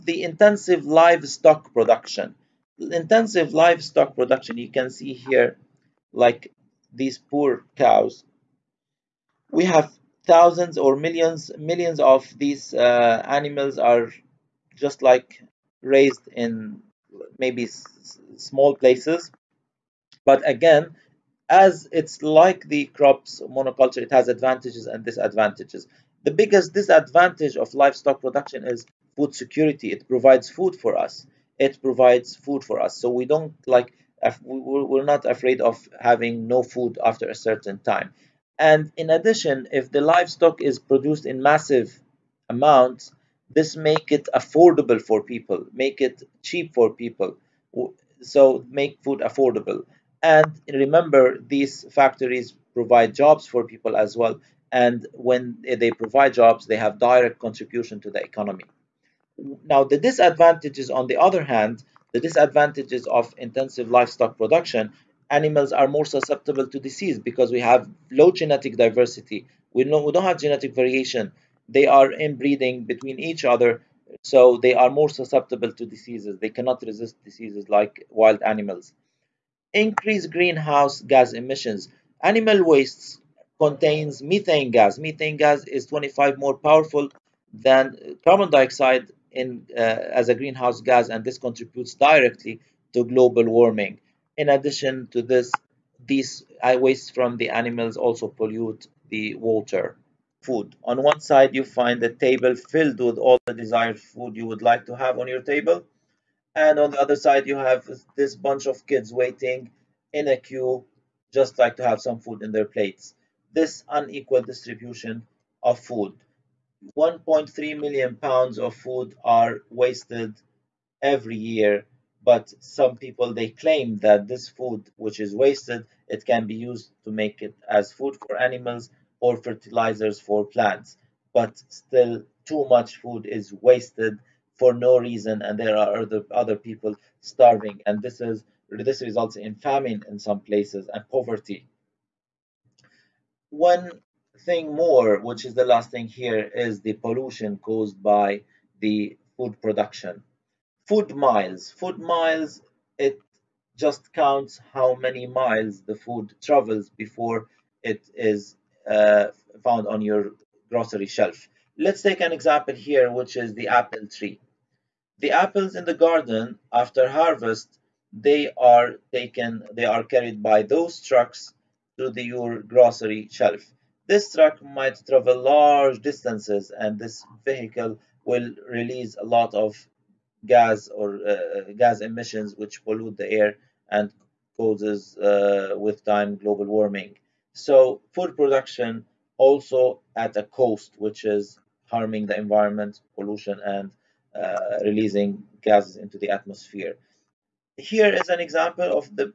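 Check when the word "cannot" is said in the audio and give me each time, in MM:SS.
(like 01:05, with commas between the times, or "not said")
01:16.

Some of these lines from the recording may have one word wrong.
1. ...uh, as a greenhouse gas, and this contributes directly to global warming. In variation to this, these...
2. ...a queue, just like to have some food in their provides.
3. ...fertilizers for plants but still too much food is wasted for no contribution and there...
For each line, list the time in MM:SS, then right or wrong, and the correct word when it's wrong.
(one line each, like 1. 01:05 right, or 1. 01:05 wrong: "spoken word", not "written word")
1. 01:29 wrong: "addition", not "variation"
2. 01:50 wrong: "plates", not "provides"
3. 02:09 wrong: "reason", not "contribution".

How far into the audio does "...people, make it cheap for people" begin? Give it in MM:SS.
00:45.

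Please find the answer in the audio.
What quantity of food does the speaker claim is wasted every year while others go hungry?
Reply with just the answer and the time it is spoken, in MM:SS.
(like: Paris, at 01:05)
1.3 million pounds, at 01:56.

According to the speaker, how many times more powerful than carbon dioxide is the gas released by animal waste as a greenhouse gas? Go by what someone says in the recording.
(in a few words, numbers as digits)
25.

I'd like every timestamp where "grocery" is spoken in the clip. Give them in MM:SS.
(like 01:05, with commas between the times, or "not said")
02:40, 02:52.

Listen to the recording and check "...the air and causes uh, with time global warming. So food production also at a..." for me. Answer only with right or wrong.
right.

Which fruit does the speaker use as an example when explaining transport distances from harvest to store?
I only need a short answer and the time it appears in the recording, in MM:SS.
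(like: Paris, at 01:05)
apples, at 02:43.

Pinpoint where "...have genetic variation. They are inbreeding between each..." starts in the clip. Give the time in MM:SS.
01:10.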